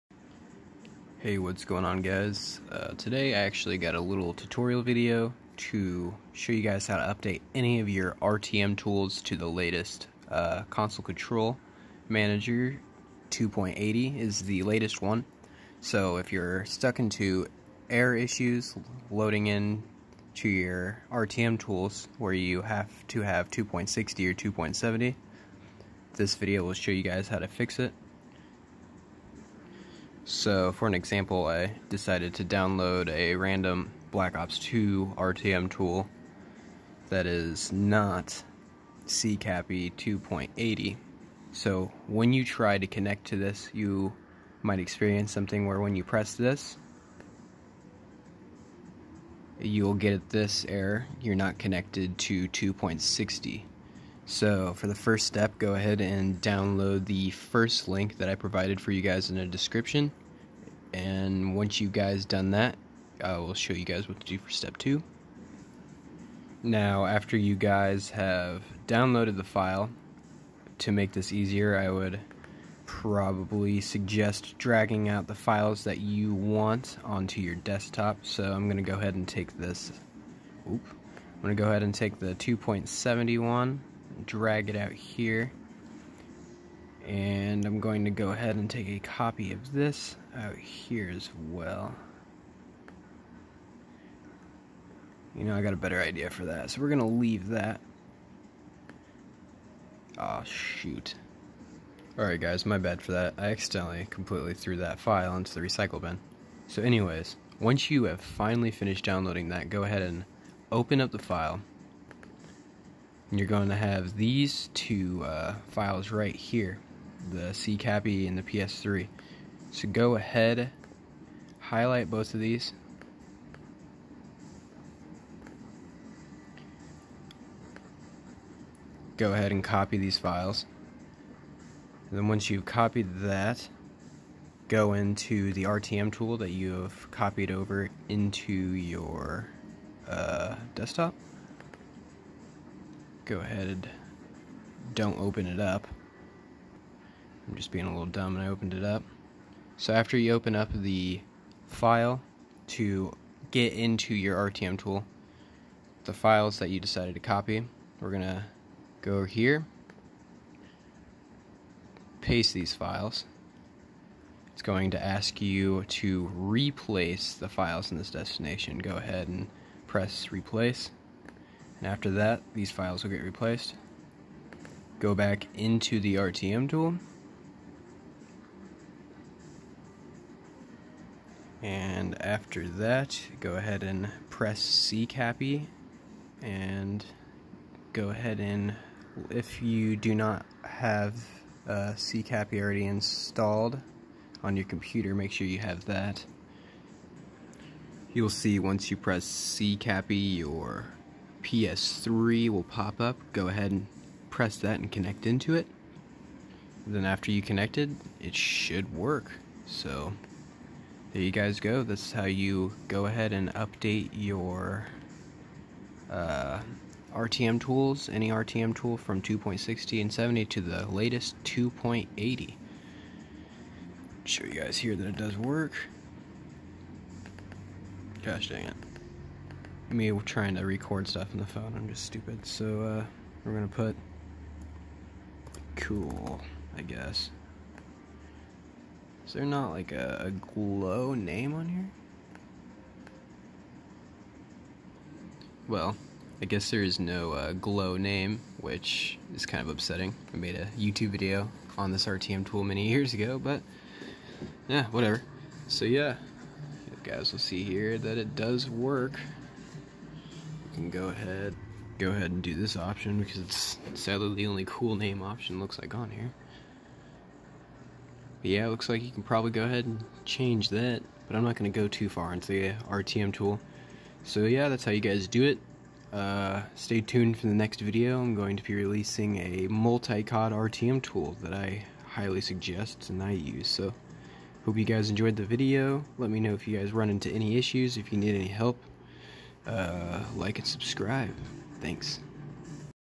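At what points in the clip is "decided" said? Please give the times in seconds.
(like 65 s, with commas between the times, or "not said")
31 s, 156 s.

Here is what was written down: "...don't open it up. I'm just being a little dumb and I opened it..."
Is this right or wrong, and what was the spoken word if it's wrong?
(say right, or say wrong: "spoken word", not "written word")
right.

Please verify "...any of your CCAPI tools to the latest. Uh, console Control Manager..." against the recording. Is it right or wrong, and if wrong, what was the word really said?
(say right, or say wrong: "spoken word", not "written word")
wrong: "RTM", not "CCAPI".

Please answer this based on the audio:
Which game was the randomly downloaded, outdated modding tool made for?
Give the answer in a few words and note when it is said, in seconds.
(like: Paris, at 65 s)
Black Ops 2, at 34 s.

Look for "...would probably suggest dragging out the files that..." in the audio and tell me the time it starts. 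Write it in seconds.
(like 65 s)
71 s.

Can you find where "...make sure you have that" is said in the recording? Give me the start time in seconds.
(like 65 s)
195 s.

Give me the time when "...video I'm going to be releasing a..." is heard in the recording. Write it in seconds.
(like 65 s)
277 s.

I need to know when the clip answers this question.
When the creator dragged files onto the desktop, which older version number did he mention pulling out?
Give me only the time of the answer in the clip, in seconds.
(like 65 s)
82 s.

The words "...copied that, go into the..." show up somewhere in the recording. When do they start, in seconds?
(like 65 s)
132 s.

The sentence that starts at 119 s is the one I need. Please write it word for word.
So go ahead, highlight both of these.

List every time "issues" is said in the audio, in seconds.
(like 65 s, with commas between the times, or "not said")
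18 s, 287 s.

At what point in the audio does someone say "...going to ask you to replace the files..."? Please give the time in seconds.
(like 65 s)
164 s.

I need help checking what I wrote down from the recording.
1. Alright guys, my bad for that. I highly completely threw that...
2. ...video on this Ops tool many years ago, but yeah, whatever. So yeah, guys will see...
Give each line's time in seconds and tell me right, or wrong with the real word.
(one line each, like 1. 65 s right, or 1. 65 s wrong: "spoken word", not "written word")
1. 102 s wrong: "accidentally", not "highly"
2. 251 s wrong: "RTM", not "Ops".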